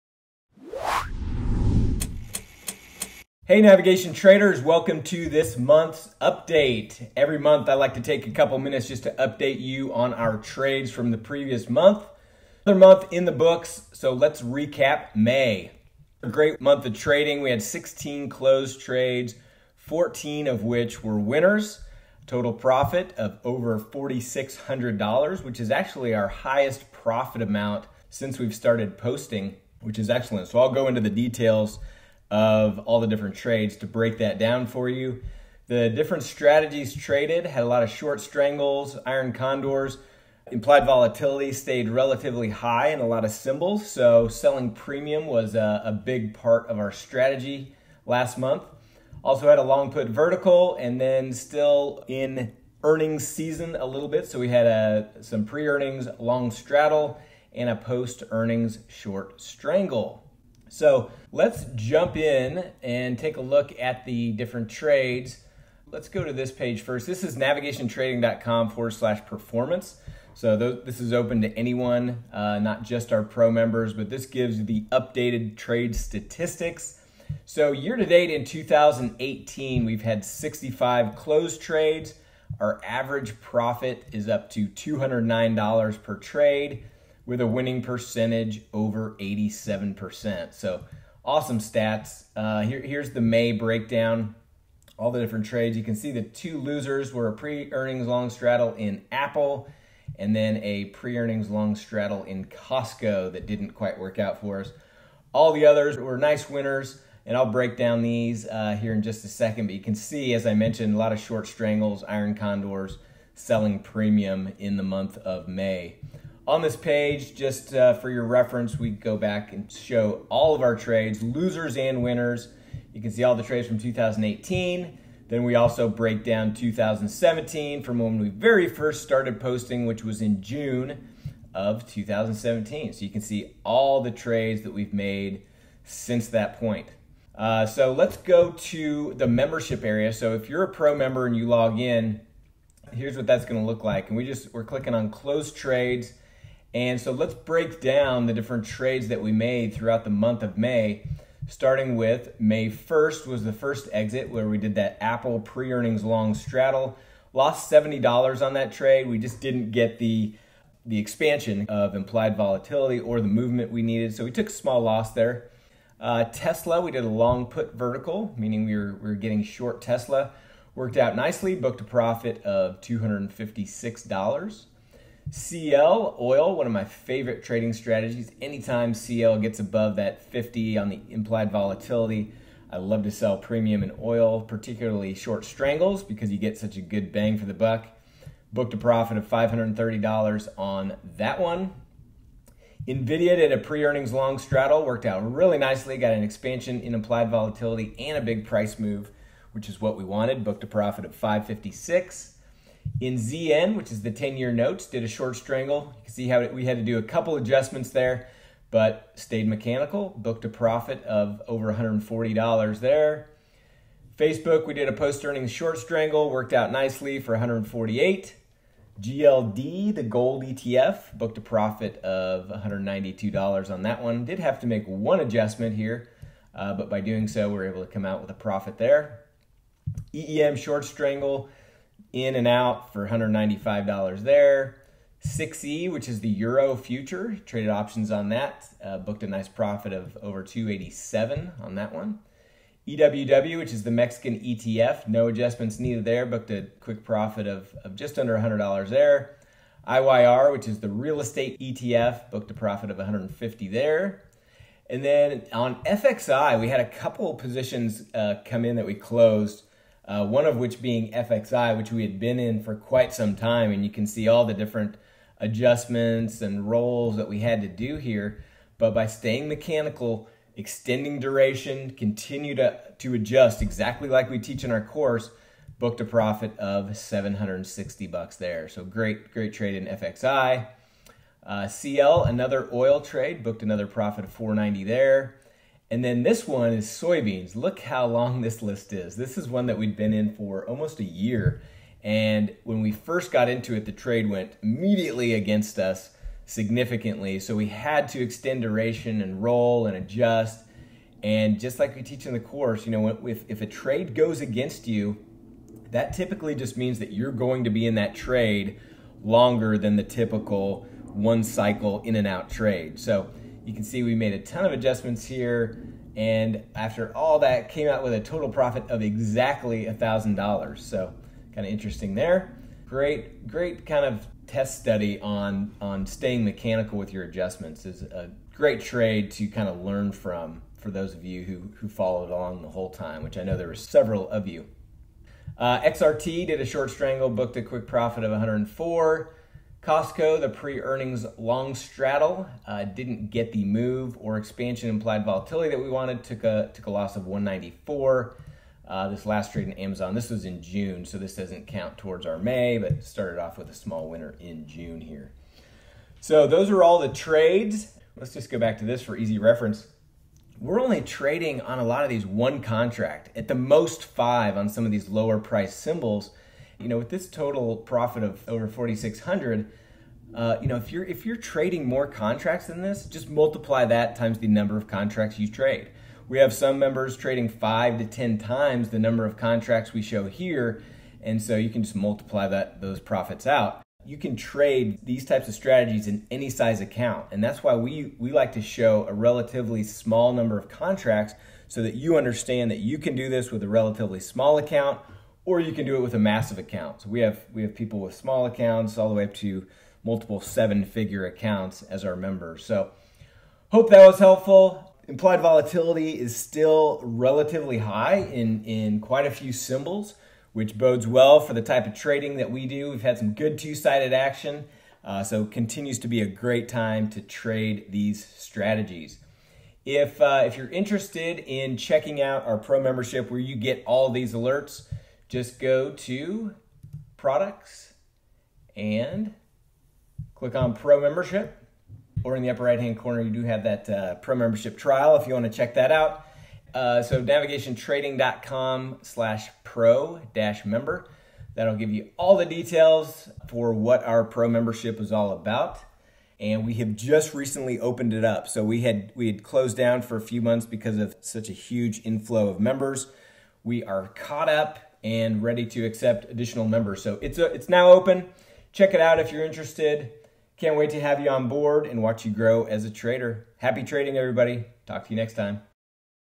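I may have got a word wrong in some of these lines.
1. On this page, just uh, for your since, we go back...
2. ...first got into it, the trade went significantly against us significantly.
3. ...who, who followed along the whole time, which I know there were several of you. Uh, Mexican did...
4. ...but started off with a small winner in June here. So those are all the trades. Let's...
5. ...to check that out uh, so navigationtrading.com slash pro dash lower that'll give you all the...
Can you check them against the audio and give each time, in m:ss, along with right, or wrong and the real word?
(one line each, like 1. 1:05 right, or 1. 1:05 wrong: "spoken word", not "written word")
1. 1:56 wrong: "reference", not "since"
2. 4:52 wrong: "immediately", not "significantly"
3. 5:31 wrong: "XRT", not "Mexican"
4. 5:52 right
5. 7:15 wrong: "member", not "lower".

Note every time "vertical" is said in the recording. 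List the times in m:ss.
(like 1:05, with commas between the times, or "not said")
0:50, 2:47.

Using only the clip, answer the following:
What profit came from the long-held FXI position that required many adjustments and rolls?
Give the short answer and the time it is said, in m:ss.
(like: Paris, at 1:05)
$760, at 4:36.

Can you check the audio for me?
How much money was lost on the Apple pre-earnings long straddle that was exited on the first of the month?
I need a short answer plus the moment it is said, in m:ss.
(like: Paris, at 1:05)
$70, at 2:37.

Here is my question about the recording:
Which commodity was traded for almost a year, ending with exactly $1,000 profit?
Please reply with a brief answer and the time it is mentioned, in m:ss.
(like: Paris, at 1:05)
soybeans, at 4:46.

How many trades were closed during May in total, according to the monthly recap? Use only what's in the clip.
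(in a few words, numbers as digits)
16.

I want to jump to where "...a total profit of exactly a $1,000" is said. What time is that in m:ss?
5:18.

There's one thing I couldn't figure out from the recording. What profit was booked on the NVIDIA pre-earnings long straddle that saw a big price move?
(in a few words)
$556.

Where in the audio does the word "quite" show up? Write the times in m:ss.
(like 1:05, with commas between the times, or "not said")
1:43, 4:22, 6:48.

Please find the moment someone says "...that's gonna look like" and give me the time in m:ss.
2:23.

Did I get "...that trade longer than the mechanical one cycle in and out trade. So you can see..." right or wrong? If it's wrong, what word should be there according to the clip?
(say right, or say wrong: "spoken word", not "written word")
wrong: "typical", not "mechanical".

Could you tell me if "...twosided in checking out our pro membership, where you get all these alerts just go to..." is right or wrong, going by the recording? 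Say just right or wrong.
wrong.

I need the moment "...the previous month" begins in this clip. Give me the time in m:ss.
0:11.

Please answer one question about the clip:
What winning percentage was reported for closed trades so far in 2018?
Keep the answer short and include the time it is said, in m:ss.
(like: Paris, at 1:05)
over 87%, at 1:28.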